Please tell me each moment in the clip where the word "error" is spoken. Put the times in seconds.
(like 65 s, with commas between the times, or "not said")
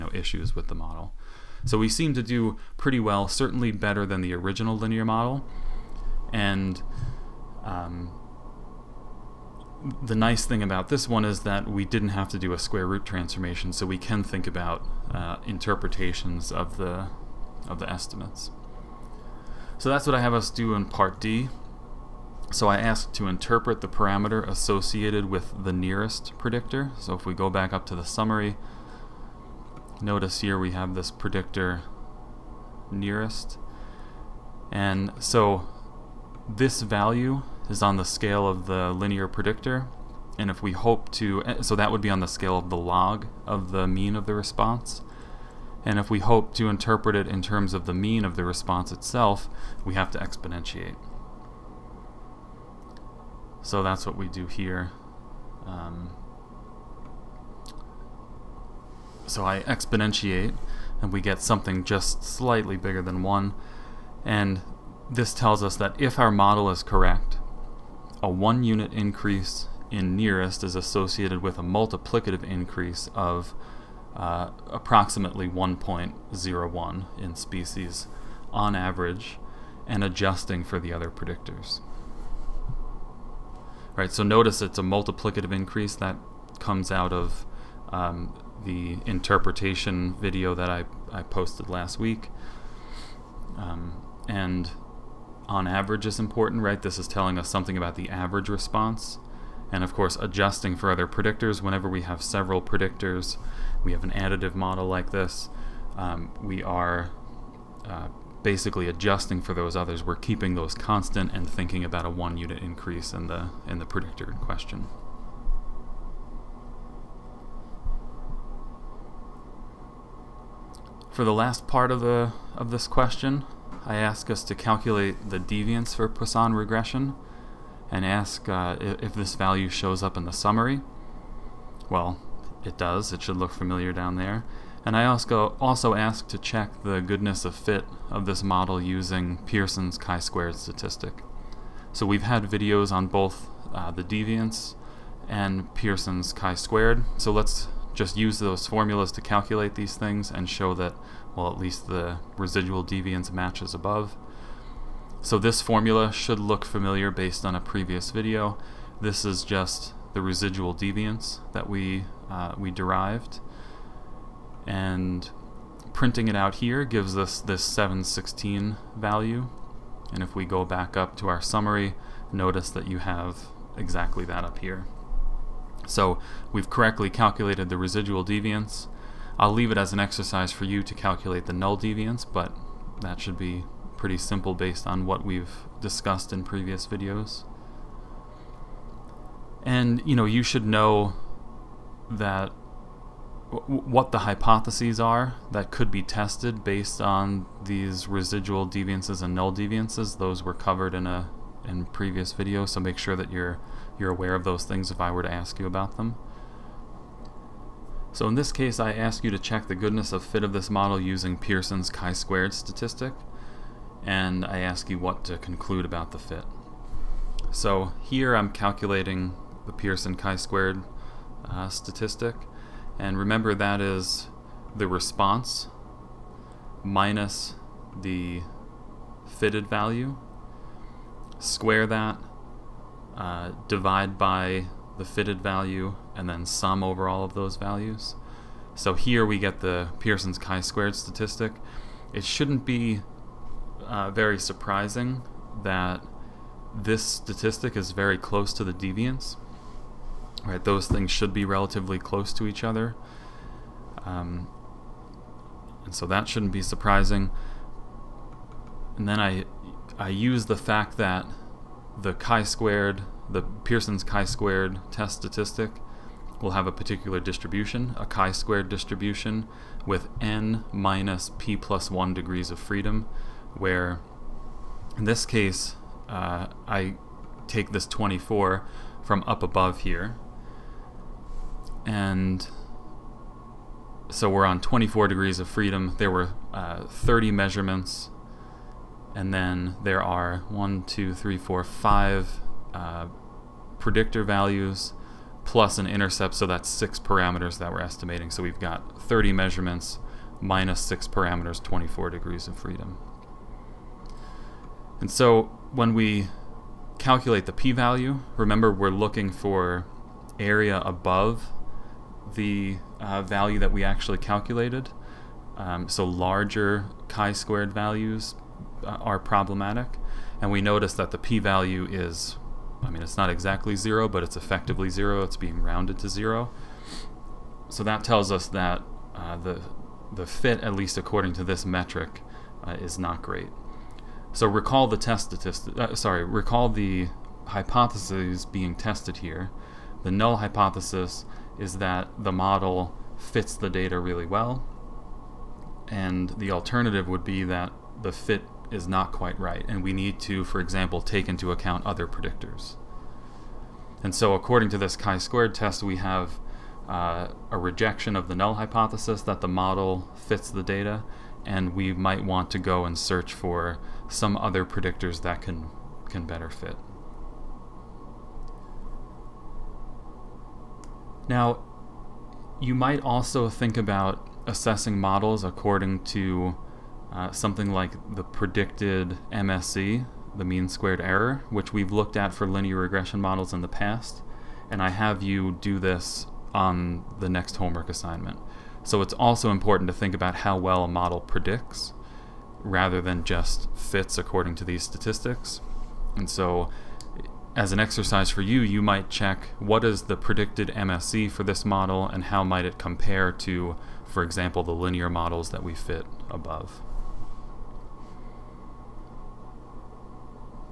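380 s.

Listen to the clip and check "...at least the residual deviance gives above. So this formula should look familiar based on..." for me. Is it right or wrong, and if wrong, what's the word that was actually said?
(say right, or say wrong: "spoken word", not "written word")
wrong: "matches", not "gives".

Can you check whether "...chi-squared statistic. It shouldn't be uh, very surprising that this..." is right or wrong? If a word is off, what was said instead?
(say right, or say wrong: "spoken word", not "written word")
right.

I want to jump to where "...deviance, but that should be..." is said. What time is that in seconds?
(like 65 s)
181 s.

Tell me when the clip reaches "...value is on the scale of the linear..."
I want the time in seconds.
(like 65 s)
36 s.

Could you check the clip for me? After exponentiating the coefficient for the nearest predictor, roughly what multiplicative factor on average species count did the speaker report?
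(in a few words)
1.01.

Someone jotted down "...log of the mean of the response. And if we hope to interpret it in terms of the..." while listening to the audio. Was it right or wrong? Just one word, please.
right.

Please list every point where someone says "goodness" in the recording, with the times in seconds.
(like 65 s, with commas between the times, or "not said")
136 s, 209 s.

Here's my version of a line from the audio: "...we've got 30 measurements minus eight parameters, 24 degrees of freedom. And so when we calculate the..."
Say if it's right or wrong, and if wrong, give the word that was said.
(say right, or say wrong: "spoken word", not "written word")
wrong: "six", not "eight".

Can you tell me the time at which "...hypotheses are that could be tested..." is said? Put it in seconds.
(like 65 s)
194 s.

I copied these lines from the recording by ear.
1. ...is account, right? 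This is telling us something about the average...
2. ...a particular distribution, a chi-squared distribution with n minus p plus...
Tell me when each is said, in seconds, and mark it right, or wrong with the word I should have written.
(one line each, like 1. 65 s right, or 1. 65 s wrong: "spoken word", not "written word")
1. 96 s wrong: "important", not "account"
2. 266 s right.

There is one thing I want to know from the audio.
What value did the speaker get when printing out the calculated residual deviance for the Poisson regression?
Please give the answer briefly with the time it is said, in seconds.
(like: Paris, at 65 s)
716, at 167 s.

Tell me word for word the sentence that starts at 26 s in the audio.
So if we go back up to the summary, Notice here we have this predictor nearest.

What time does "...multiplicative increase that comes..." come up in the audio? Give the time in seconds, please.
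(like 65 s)
84 s.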